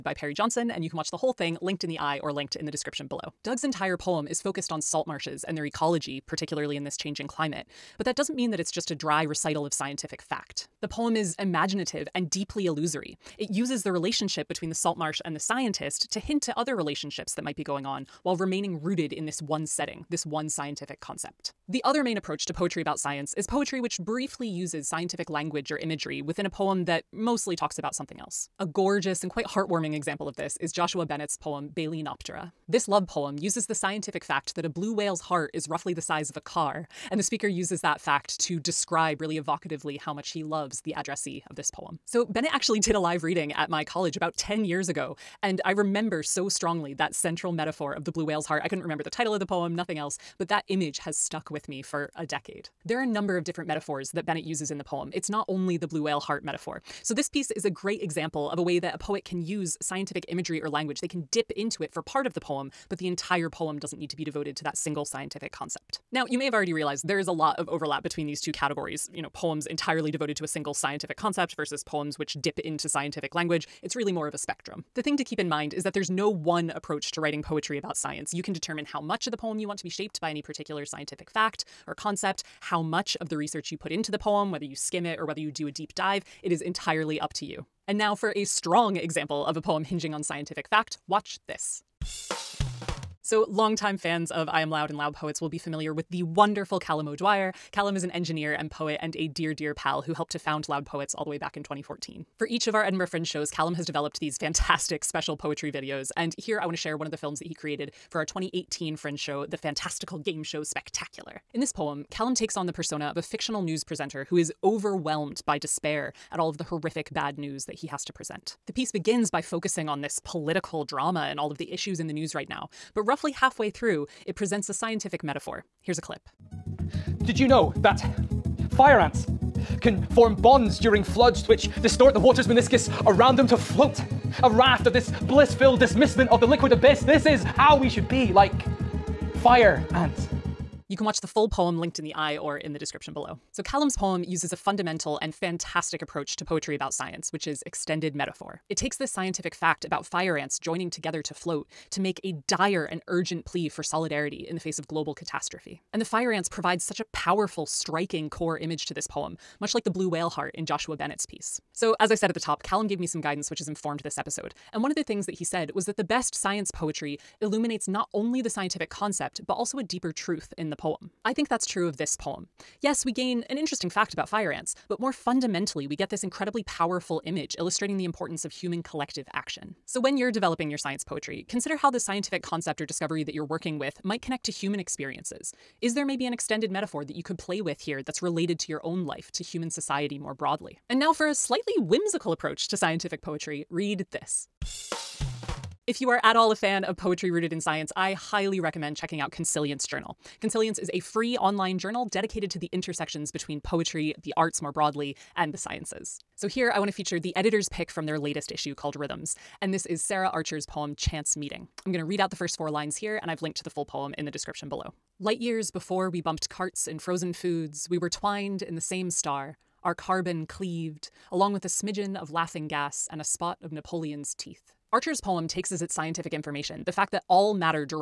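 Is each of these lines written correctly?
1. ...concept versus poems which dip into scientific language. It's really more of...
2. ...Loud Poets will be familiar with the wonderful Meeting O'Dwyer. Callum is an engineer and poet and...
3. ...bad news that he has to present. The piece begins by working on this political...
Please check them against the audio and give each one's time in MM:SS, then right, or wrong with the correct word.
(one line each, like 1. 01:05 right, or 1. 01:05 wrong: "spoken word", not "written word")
1. 01:11 right
2. 01:34 wrong: "Callum", not "Meeting"
3. 01:57 wrong: "focusing", not "working".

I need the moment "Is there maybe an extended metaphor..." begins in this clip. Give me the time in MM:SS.
03:05.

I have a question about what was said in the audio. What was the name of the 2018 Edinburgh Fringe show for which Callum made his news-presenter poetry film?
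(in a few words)
The Fantastical Game Show Spectacular.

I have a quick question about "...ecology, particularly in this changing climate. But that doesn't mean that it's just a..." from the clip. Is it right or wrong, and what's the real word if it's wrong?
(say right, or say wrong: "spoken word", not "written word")
right.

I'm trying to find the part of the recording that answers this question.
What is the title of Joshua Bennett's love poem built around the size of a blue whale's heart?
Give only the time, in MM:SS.
00:31.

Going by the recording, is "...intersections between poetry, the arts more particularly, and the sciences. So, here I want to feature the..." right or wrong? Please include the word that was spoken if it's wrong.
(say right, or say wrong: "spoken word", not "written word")
wrong: "broadly", not "particularly".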